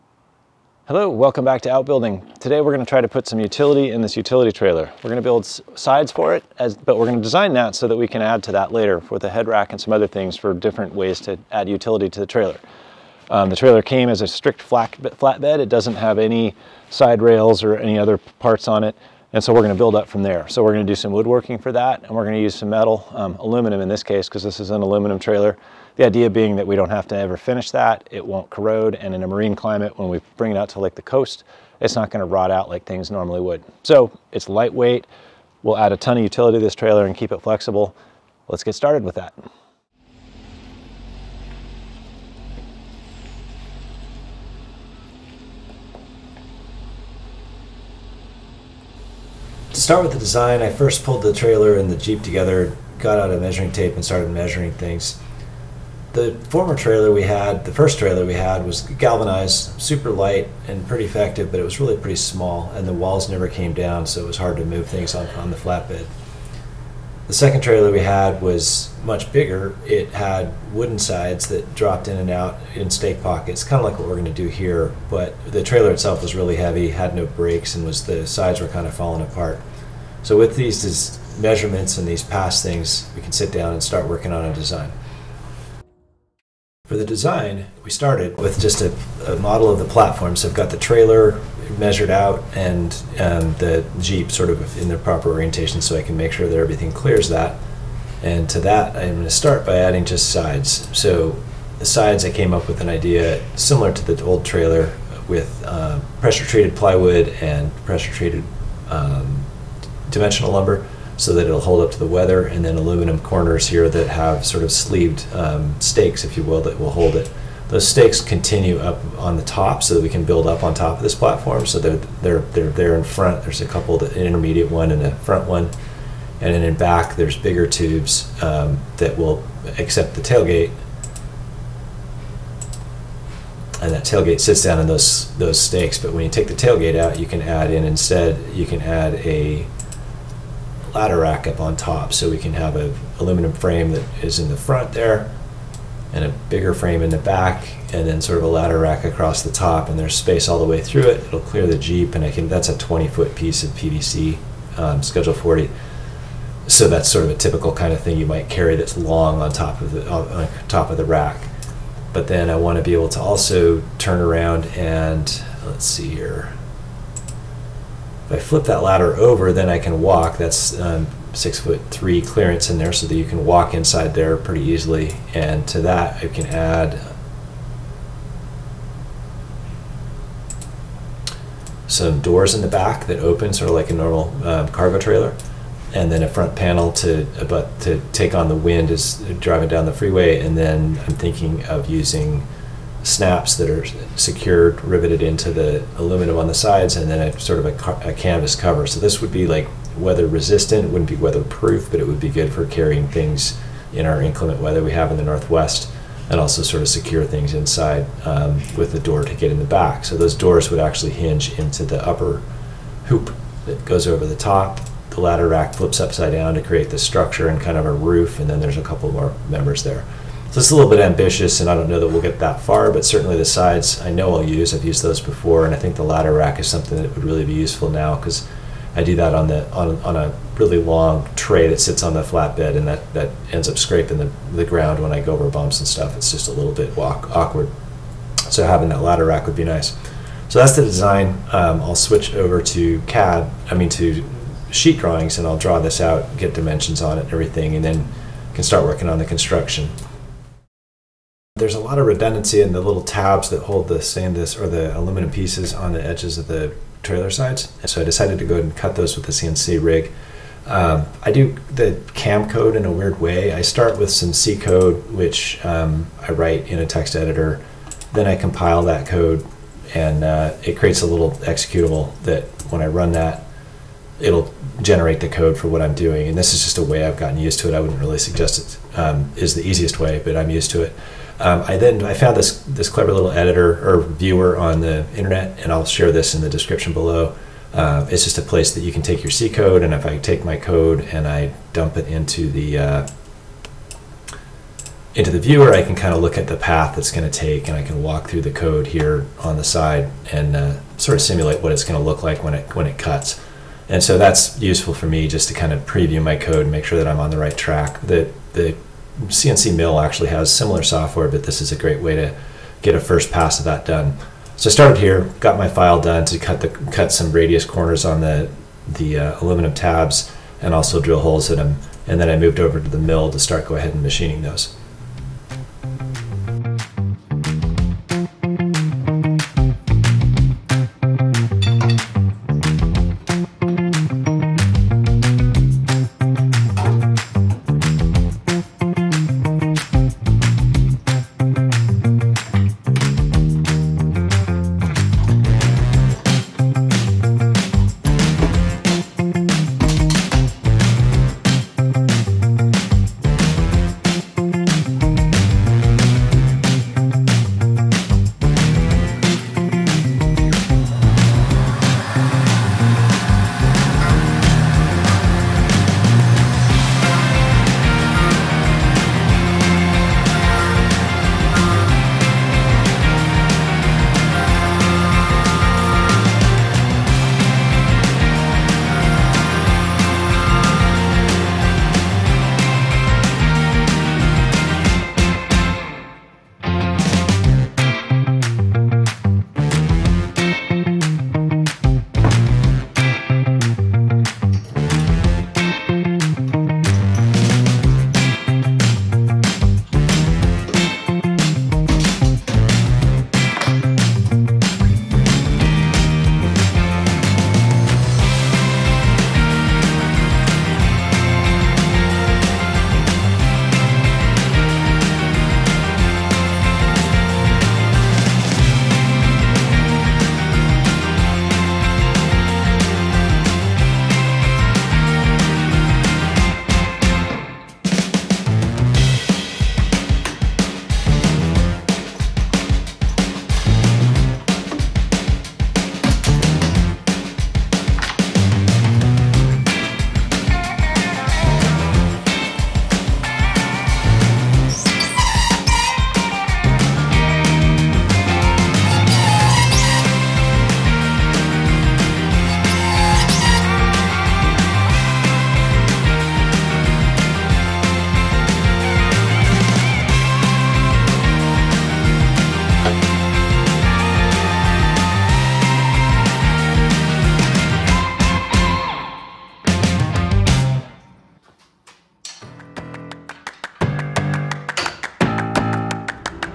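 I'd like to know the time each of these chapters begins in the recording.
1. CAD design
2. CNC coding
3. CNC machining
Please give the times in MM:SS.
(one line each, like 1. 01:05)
1. 01:26
2. 04:11
3. 05:26.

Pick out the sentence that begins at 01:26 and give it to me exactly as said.
For the design, we started with just a, a model of the platform.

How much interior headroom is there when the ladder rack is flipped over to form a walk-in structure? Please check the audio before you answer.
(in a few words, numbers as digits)
6 foot 3.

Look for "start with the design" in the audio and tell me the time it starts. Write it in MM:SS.
00:49.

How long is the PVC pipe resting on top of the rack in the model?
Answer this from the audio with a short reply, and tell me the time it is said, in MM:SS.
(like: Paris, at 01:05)
20 foot, at 02:32.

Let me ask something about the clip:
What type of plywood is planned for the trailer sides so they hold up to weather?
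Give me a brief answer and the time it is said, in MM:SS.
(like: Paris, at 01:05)
pressure treated plywood, at 01:46.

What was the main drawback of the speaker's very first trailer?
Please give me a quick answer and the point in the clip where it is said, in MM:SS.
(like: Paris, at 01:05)
really pretty small, at 01:01.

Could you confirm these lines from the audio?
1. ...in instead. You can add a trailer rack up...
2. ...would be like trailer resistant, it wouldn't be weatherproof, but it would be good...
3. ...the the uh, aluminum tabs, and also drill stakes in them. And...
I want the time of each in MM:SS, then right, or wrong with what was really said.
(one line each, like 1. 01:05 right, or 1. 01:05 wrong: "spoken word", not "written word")
1. 02:17 wrong: "ladder", not "trailer"
2. 03:19 wrong: "weather", not "trailer"
3. 05:18 wrong: "holes", not "stakes".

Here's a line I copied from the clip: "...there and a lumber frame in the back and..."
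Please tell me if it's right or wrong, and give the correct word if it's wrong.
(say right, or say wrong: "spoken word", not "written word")
wrong: "bigger", not "lumber".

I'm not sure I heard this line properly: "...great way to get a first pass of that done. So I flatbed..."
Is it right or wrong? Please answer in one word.
wrong.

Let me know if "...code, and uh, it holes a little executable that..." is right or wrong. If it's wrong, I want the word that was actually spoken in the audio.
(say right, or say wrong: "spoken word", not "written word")
wrong: "creates", not "holes".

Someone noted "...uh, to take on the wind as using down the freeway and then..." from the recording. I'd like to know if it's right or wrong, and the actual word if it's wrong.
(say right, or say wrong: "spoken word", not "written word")
wrong: "driving", not "using".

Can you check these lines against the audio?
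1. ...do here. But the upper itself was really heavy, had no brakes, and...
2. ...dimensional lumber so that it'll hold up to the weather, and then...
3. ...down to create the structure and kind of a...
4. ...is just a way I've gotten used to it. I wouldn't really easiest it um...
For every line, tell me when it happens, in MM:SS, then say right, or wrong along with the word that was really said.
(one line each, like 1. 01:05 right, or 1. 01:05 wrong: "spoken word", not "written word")
1. 01:14 wrong: "trailer", not "upper"
2. 01:50 right
3. 03:36 right
4. 04:36 wrong: "suggest", not "easiest".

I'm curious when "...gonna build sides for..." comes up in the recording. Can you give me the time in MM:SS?
00:05.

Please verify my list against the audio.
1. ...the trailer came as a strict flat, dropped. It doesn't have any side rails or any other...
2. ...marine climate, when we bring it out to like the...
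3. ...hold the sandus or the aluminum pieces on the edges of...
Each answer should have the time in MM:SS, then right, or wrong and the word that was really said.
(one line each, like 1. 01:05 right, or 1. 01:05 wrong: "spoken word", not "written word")
1. 00:13 wrong: "flatbed", not "dropped"
2. 00:29 right
3. 04:13 right.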